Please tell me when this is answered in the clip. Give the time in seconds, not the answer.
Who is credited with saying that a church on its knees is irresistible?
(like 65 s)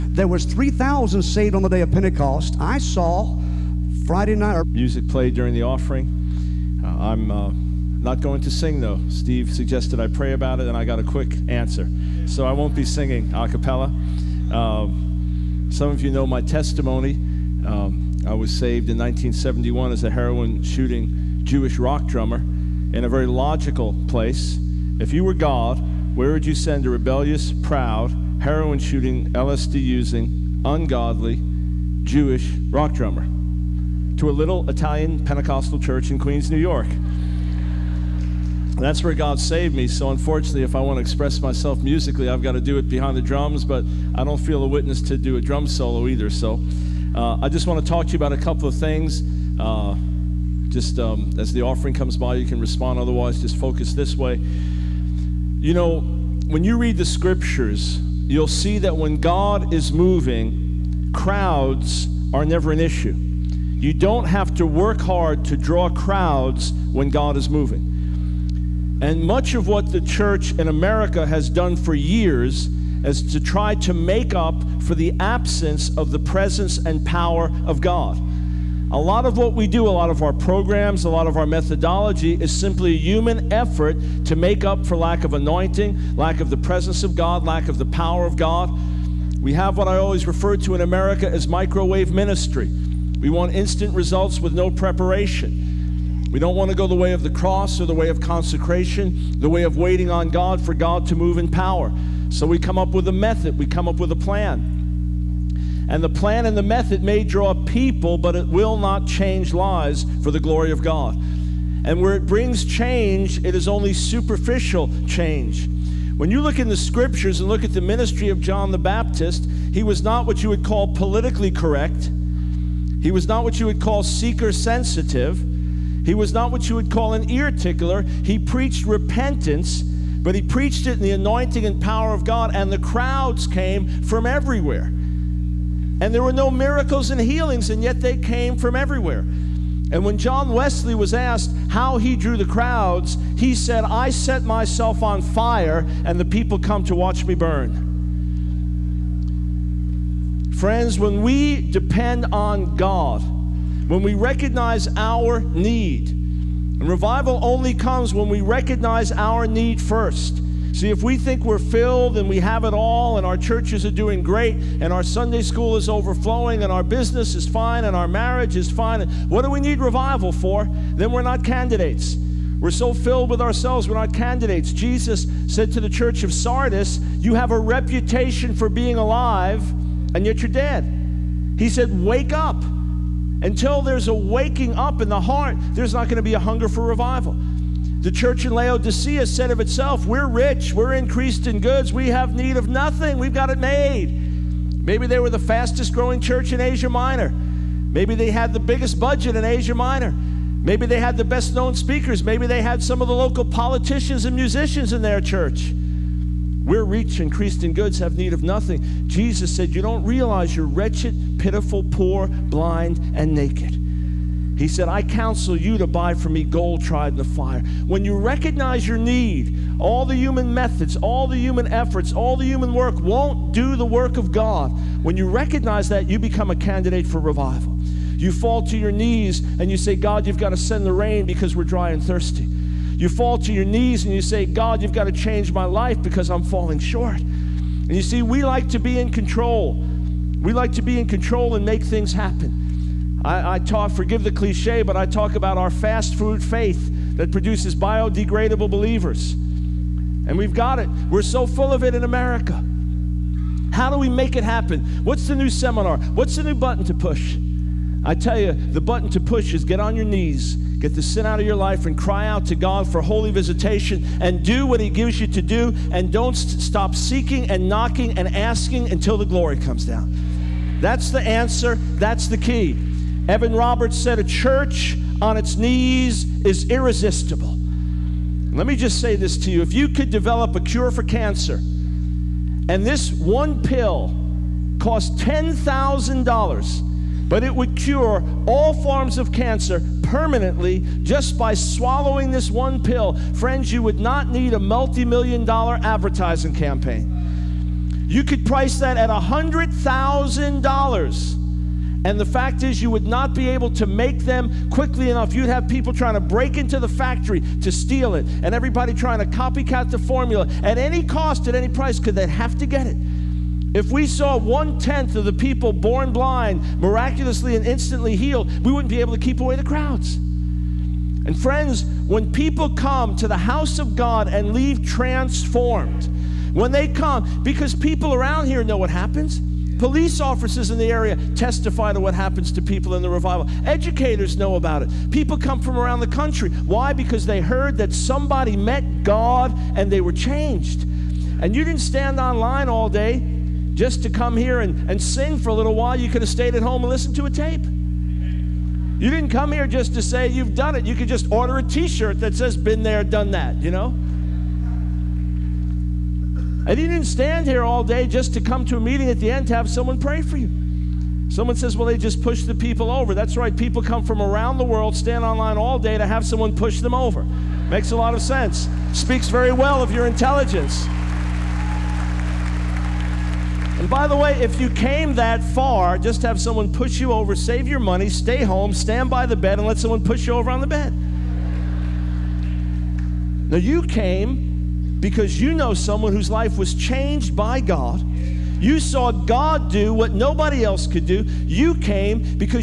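273 s.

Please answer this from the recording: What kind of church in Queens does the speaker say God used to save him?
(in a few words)
Italian Pentecostal church.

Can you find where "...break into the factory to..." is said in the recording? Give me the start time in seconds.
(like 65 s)
306 s.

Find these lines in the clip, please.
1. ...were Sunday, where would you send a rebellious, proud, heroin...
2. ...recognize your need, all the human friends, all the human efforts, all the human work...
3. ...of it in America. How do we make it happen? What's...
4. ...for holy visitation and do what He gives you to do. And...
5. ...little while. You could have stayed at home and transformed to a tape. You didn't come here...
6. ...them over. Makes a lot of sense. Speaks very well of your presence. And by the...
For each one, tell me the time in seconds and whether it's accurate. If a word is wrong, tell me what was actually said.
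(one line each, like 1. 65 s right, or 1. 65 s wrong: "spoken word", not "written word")
1. 25 s wrong: "God", not "Sunday"
2. 218 s wrong: "methods", not "friends"
3. 251 s right
4. 262 s right
5. 345 s wrong: "listened", not "transformed"
6. 366 s wrong: "intelligence", not "presence".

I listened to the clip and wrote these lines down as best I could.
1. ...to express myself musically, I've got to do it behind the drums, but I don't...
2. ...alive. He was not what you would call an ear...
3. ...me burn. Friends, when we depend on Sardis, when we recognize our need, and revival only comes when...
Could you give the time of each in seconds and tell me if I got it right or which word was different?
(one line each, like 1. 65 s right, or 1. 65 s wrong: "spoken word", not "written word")
1. 40 s right
2. 124 s wrong: "sensitive", not "alive"
3. 147 s wrong: "God", not "Sardis".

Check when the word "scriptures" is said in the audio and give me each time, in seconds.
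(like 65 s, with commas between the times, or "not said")
57 s, 116 s.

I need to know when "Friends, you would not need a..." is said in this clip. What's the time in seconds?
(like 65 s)
293 s.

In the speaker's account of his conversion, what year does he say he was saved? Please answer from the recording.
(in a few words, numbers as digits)
1971.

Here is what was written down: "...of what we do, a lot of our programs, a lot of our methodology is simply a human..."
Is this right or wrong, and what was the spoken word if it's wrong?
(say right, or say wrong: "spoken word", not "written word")
right.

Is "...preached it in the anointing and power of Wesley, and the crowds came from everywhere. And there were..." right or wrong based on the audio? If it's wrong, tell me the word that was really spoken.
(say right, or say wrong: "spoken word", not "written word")
wrong: "God", not "Wesley".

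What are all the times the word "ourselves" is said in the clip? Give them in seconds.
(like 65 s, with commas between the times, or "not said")
173 s.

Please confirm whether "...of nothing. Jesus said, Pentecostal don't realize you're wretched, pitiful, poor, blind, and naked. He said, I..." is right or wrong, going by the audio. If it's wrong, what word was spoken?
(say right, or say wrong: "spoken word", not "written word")
wrong: "You", not "Pentecostal".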